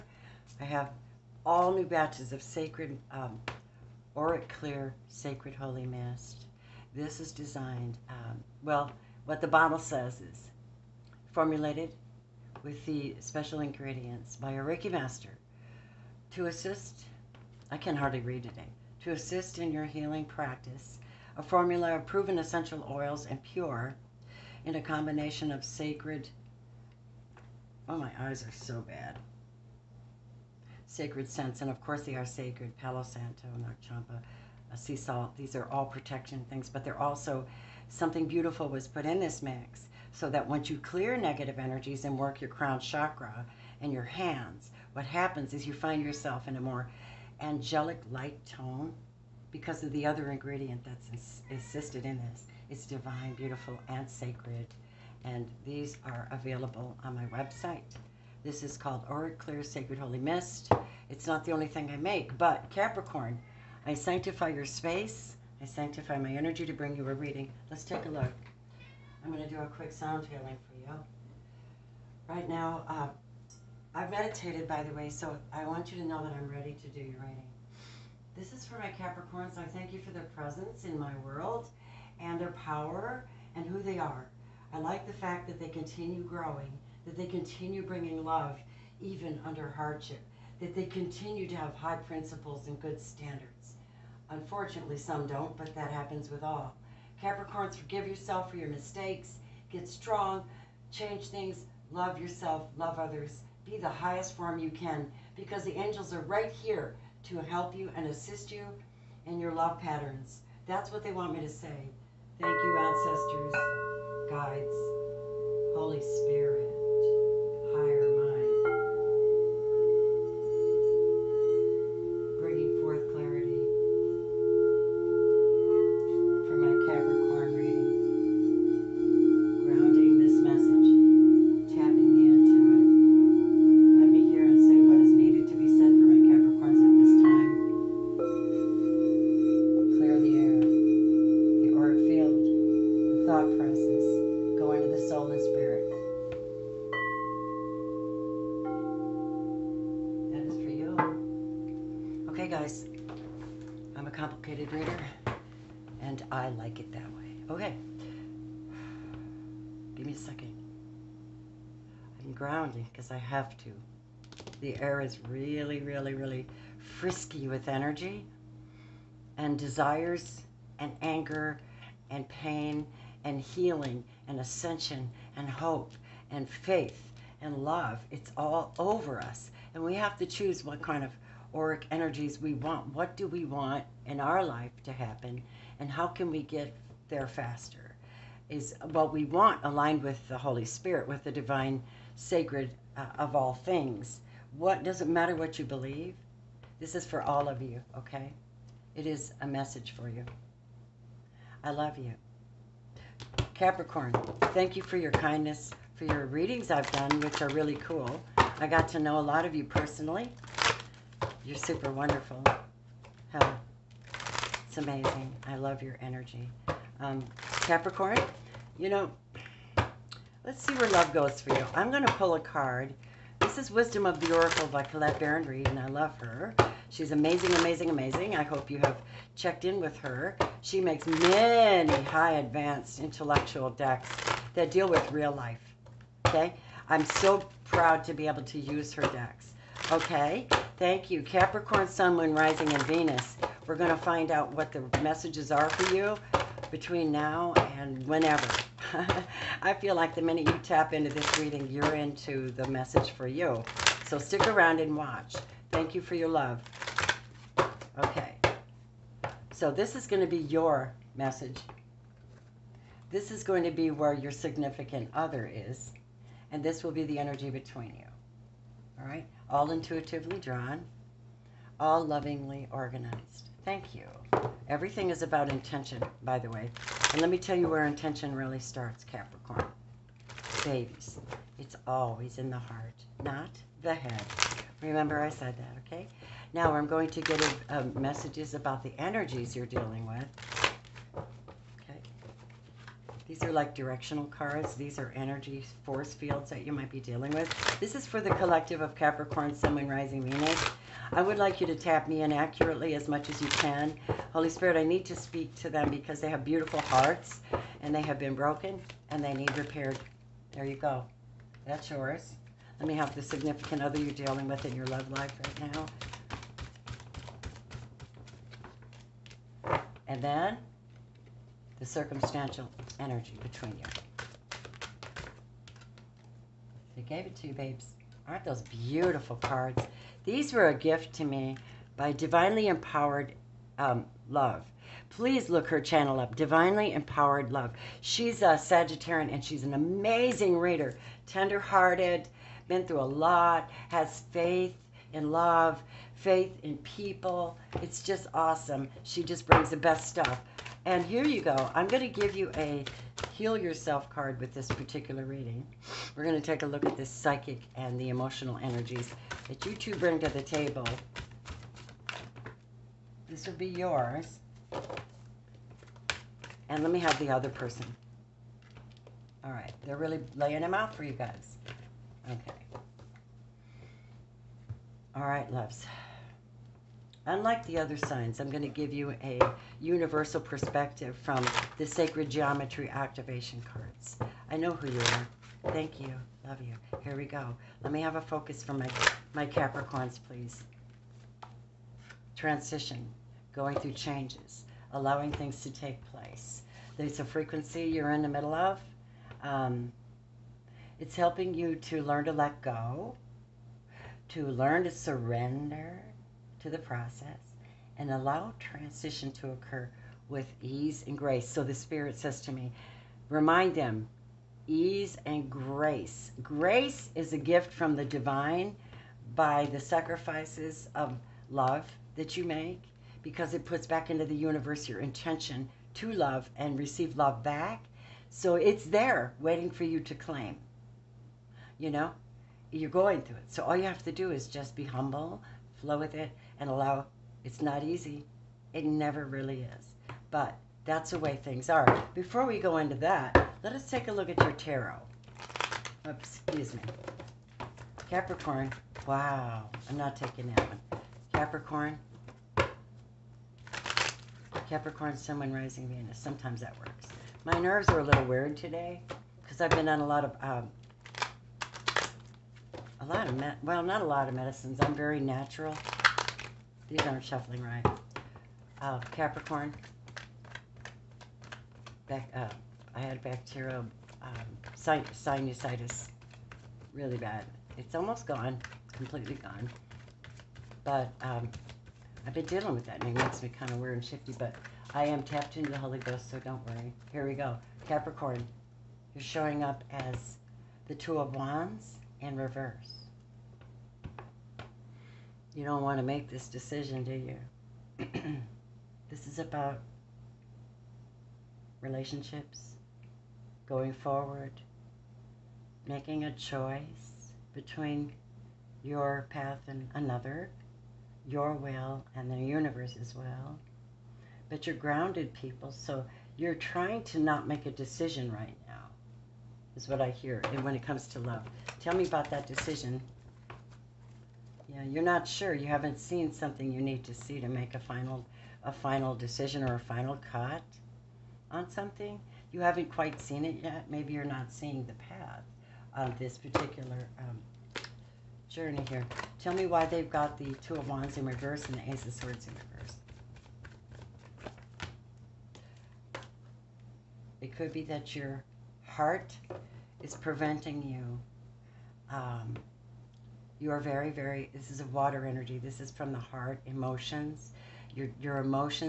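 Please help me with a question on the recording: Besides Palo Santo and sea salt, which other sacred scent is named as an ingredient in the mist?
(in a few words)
Champa.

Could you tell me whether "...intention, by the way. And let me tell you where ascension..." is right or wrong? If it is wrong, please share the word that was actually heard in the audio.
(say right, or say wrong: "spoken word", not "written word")
wrong: "intention", not "ascension".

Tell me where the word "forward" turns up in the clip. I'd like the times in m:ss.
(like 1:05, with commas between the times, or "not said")
8:23.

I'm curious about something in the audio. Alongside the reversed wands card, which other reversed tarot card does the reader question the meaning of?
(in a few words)
Ace of Swords.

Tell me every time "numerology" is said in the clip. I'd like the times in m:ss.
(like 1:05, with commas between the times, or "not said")
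not said.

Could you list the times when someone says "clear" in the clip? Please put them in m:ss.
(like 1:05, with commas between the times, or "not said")
0:04, 0:40, 0:59.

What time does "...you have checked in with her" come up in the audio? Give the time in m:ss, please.
3:48.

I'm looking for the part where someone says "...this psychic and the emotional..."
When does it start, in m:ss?
5:56.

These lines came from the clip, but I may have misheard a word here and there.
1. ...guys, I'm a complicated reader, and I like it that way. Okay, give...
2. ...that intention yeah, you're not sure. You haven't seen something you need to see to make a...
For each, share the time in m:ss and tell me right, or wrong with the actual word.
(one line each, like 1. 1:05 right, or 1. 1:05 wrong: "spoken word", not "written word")
1. 2:32 right
2. 8:42 wrong: "decision", not "intention".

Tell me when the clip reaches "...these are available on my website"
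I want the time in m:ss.
0:55.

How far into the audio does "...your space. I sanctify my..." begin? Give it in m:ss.
1:04.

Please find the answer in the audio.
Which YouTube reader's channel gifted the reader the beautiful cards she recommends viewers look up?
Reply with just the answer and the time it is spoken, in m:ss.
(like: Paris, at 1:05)
Divinely Empowered Love, at 5:36.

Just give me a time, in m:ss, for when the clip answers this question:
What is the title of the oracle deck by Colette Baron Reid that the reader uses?
3:43.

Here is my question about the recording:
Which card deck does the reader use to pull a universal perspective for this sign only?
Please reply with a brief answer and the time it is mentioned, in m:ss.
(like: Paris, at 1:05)
Sacred Geometry Activation Cards, at 6:21.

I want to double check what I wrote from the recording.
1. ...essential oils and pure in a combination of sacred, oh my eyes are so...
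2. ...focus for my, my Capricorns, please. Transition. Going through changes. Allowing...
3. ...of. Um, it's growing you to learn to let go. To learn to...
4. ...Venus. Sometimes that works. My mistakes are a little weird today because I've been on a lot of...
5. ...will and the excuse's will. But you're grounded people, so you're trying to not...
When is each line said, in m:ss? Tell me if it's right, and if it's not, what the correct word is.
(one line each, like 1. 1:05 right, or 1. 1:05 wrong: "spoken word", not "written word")
1. 0:22 right
2. 6:28 right
3. 6:38 wrong: "helping", not "growing"
4. 7:35 wrong: "nerves", not "mistakes"
5. 8:31 wrong: "universe", not "excuse".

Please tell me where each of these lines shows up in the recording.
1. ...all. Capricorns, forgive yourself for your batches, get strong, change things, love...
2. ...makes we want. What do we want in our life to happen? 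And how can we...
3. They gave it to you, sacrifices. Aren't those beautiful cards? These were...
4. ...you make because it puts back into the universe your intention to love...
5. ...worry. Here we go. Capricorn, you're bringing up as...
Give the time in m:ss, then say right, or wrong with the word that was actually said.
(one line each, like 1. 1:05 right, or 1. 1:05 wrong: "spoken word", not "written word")
1. 1:36 wrong: "mistakes", not "batches"
2. 3:01 wrong: "energies", not "makes"
3. 5:26 wrong: "babes", not "sacrifices"
4. 7:02 right
5. 8:06 wrong: "showing", not "bringing".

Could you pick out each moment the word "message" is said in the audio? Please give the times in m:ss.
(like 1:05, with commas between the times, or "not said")
3:19, 4:05, 4:12, 4:21, 4:47.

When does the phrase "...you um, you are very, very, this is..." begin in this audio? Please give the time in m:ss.
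9:10.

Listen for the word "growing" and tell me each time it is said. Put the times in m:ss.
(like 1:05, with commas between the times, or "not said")
1:26.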